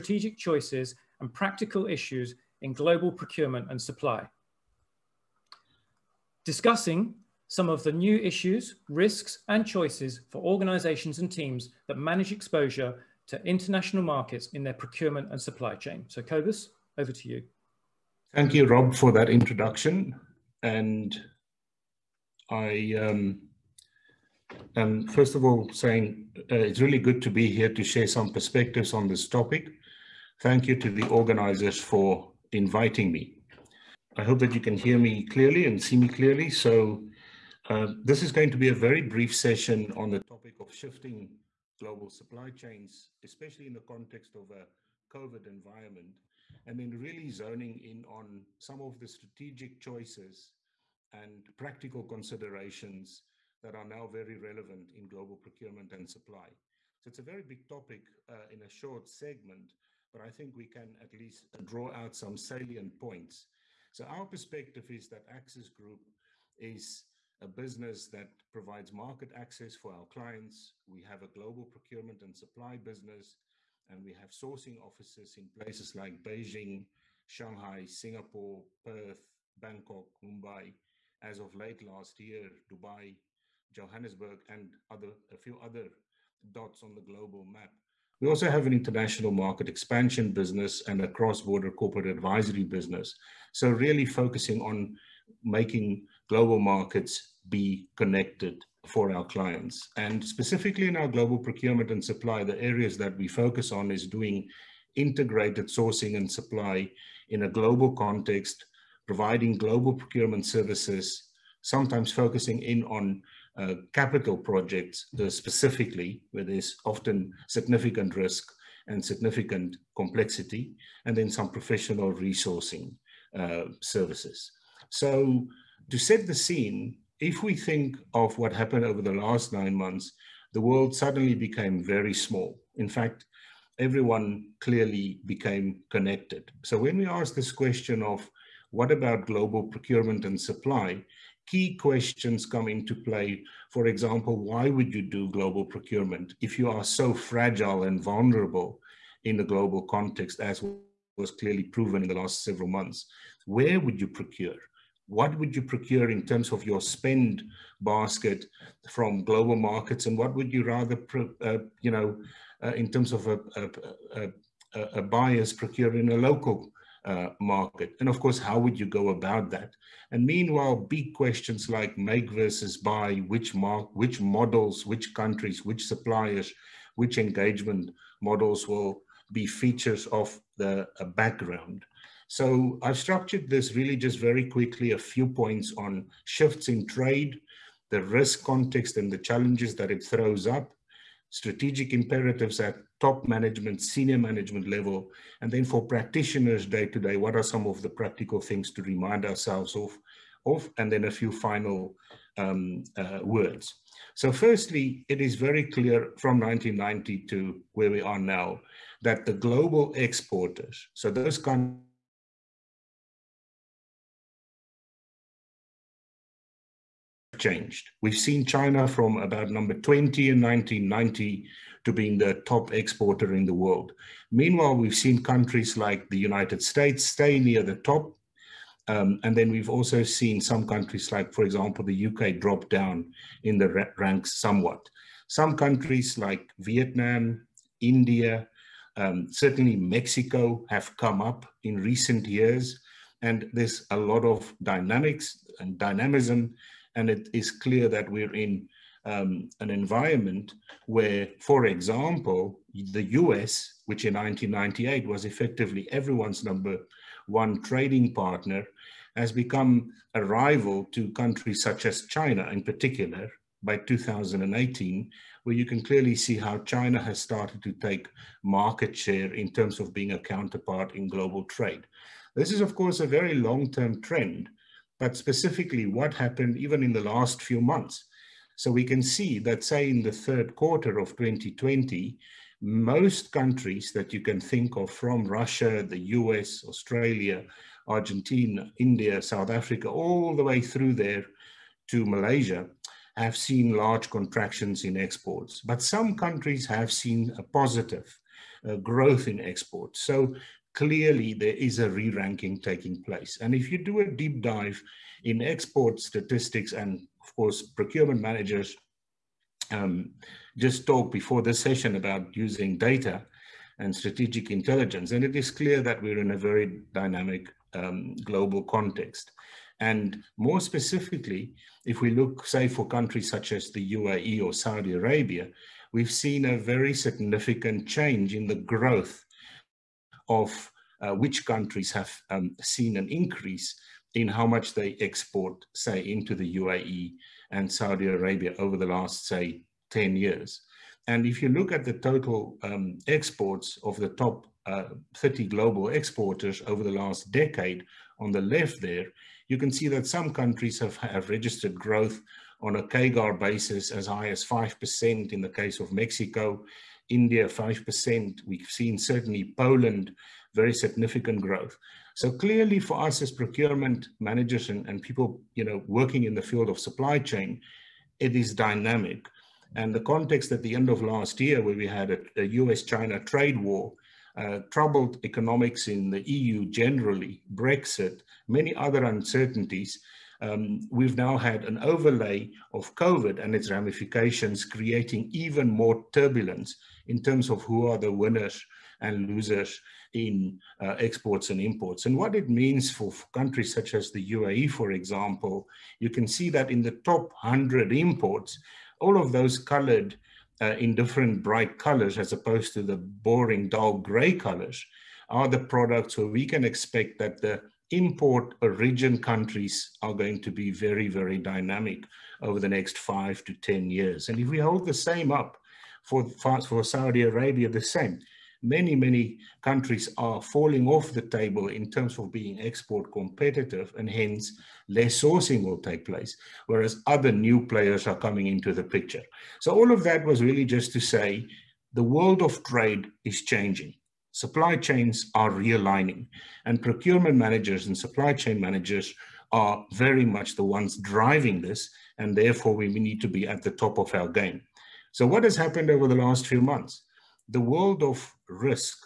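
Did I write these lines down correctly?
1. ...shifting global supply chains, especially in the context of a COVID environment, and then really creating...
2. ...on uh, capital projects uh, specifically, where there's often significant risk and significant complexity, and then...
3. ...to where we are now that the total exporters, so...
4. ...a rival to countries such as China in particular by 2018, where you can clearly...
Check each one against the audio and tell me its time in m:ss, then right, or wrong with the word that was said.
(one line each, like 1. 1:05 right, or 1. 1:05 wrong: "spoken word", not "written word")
1. 0:40 wrong: "zoning", not "creating"
2. 1:52 right
3. 3:27 wrong: "global", not "total"
4. 4:20 right.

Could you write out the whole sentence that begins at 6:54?
And if we hold the same up for, for Saudi Arabia the same.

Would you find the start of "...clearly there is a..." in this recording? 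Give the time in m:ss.
5:00.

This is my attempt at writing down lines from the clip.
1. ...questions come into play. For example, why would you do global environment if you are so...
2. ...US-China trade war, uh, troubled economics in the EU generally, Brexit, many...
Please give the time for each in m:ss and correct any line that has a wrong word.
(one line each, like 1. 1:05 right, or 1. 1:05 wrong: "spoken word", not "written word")
1. 2:21 wrong: "procurement", not "environment"
2. 6:12 right.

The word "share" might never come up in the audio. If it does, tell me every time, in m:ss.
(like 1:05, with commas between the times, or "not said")
0:27, 4:28.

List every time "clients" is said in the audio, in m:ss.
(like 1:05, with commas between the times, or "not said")
1:10, 1:39.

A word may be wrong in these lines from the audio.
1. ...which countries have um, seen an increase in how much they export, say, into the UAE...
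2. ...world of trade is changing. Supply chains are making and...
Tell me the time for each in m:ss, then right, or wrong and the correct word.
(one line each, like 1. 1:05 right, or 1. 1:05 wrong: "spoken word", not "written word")
1. 5:31 right
2. 7:12 wrong: "realigning", not "making".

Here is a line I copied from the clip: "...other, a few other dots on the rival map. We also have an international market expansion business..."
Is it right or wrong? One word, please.
wrong.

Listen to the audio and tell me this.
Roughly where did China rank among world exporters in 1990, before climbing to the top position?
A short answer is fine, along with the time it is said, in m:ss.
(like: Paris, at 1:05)
20, at 3:39.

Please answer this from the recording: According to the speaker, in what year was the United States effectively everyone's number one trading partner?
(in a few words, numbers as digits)
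1998.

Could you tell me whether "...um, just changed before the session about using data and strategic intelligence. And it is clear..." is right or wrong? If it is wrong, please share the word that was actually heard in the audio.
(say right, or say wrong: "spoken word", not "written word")
wrong: "talked", not "changed".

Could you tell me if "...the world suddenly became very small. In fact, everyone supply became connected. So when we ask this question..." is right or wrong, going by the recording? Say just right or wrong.
wrong.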